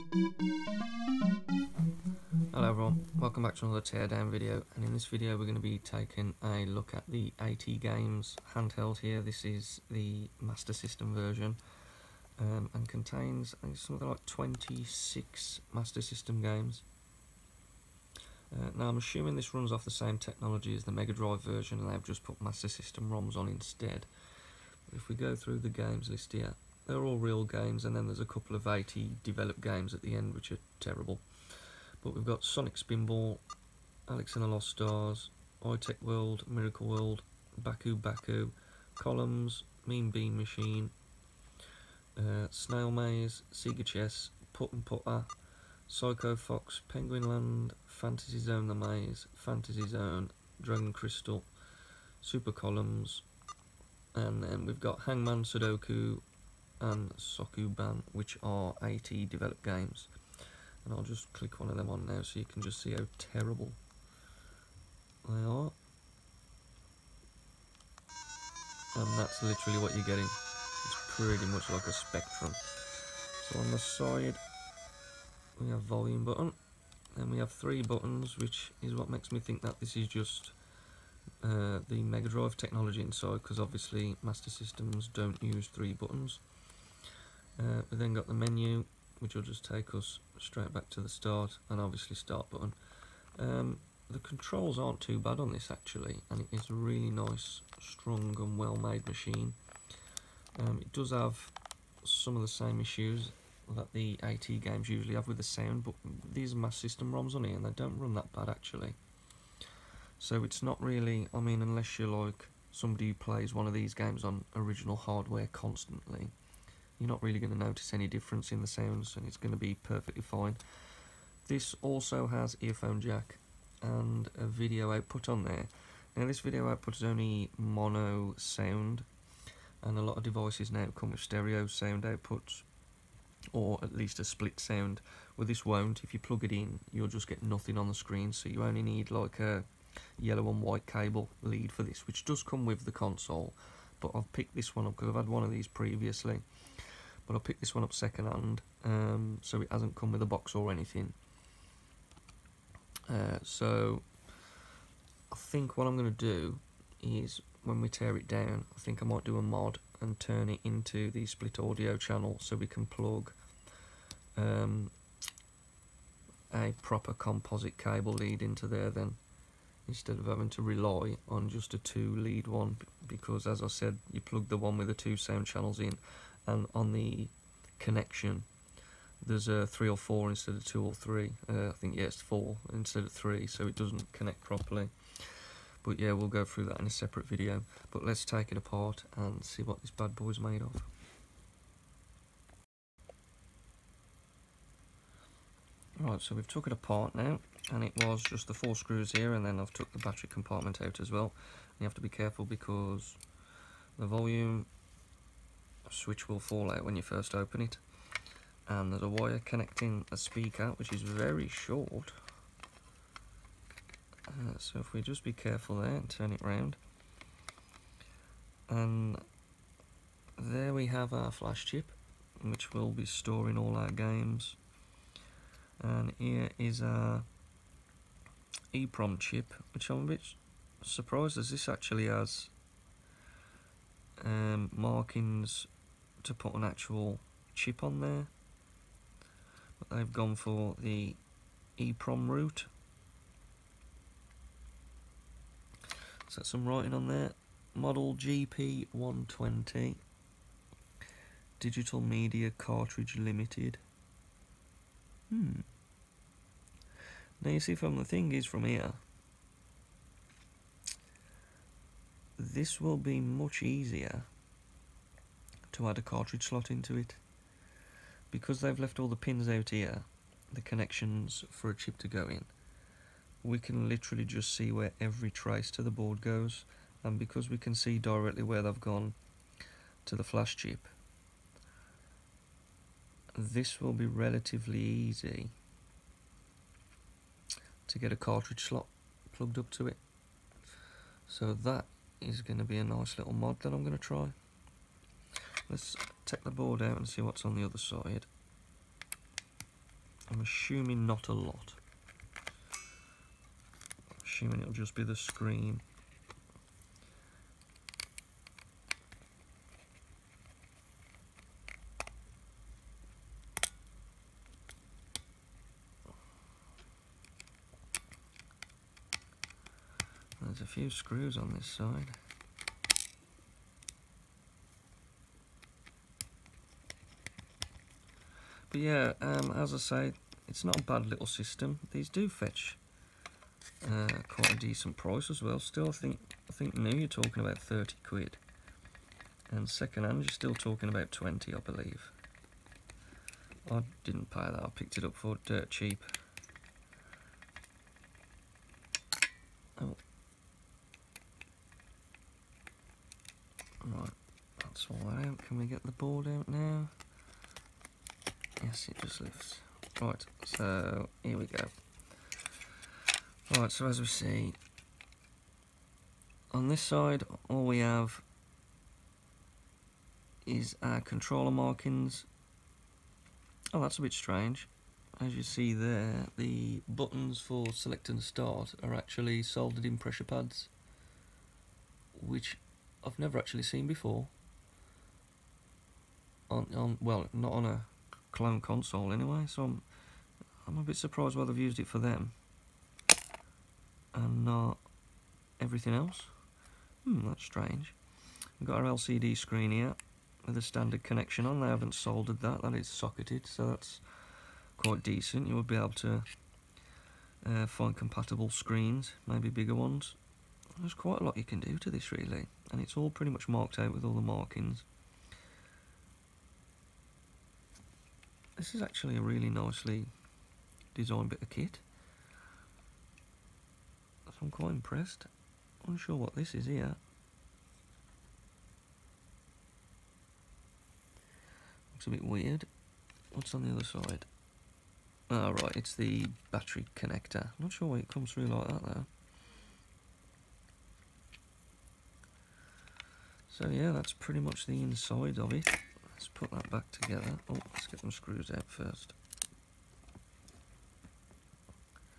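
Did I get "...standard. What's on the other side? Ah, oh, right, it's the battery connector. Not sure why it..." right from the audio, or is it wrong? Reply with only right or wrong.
wrong.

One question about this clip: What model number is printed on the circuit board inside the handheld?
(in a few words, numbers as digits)
GP120.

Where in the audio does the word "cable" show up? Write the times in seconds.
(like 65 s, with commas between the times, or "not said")
140 s, 167 s.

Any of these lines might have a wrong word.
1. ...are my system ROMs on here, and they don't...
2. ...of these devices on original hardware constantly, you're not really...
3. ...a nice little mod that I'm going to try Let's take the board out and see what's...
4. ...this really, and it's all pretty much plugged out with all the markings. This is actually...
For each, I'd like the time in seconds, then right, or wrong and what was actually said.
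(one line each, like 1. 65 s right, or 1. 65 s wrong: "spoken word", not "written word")
1. 106 s right
2. 113 s wrong: "games", not "devices"
3. 292 s right
4. 411 s wrong: "marked", not "plugged".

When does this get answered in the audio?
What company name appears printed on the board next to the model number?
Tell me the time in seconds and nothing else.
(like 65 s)
251 s.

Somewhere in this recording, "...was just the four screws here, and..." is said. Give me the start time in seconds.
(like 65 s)
198 s.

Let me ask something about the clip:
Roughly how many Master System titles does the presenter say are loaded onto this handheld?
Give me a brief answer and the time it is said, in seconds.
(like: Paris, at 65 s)
26, at 14 s.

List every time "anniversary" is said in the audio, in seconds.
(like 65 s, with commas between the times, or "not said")
not said.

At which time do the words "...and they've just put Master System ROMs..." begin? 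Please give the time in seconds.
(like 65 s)
21 s.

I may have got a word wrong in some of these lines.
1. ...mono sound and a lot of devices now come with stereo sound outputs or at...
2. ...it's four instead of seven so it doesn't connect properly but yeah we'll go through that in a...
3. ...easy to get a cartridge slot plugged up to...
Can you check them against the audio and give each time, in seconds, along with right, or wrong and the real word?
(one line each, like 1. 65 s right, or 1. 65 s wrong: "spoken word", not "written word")
1. 127 s right
2. 182 s wrong: "three", not "seven"
3. 284 s right.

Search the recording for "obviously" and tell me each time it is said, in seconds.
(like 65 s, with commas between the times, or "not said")
83 s, 91 s.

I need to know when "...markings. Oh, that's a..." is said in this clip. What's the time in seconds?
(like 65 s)
371 s.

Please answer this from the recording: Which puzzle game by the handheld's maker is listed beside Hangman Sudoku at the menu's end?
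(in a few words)
Sokoban.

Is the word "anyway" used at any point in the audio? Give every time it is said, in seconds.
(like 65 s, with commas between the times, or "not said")
389 s.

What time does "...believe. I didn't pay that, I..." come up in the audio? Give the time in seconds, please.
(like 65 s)
341 s.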